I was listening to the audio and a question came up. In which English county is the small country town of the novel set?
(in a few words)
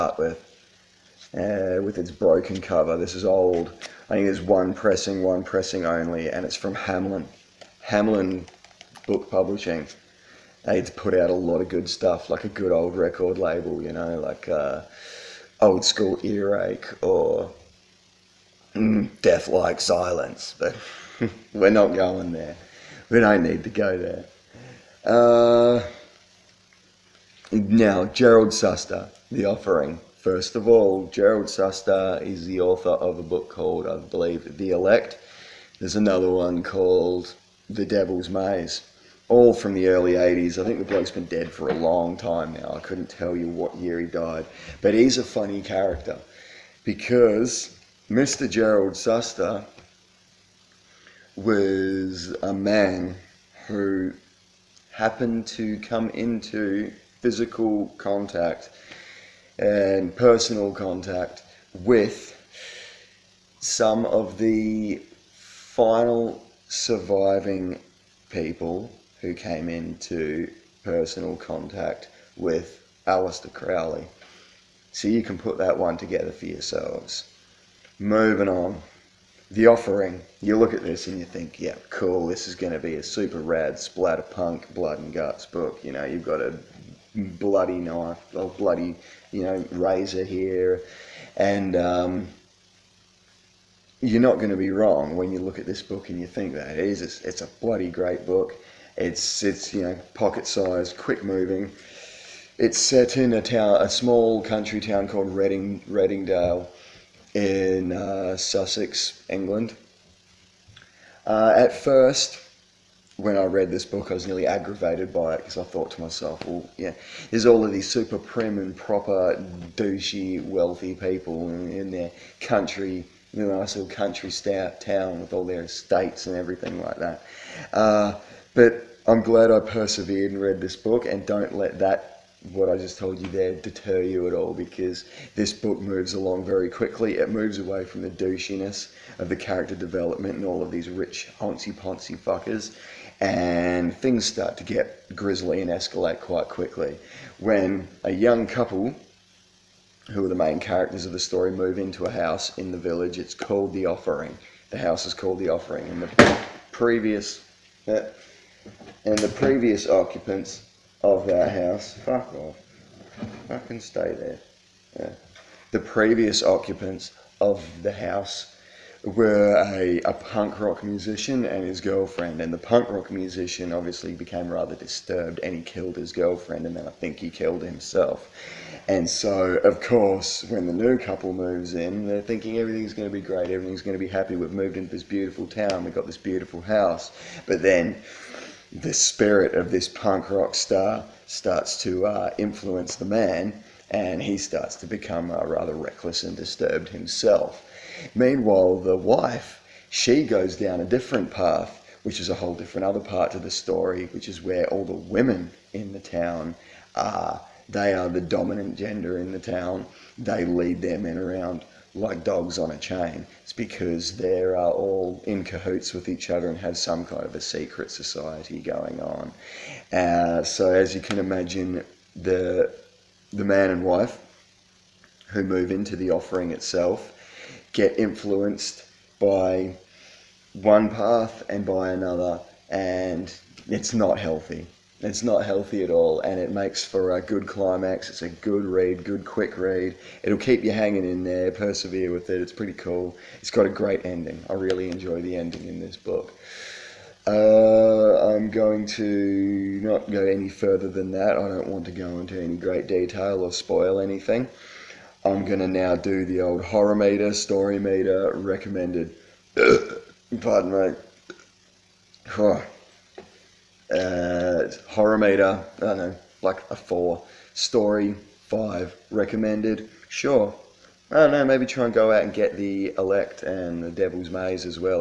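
Sussex.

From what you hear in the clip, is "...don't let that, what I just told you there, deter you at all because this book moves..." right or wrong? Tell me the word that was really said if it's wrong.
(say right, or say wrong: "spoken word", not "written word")
right.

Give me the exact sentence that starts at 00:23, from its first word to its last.
We don't need to go there.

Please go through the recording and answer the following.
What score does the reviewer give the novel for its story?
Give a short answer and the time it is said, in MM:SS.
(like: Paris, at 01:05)
5, at 04:27.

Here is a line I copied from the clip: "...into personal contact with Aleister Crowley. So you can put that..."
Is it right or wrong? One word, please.
right.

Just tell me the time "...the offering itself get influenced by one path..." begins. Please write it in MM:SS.
03:45.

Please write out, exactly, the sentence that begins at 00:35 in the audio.
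There's another one called The Devil's Maze, all from the early 80s.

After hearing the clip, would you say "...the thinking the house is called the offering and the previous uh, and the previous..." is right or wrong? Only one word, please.
wrong.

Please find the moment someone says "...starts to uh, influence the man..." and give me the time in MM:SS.
03:11.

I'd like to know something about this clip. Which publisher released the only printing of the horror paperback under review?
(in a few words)
Hamlyn.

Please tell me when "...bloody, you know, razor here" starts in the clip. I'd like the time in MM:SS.
01:28.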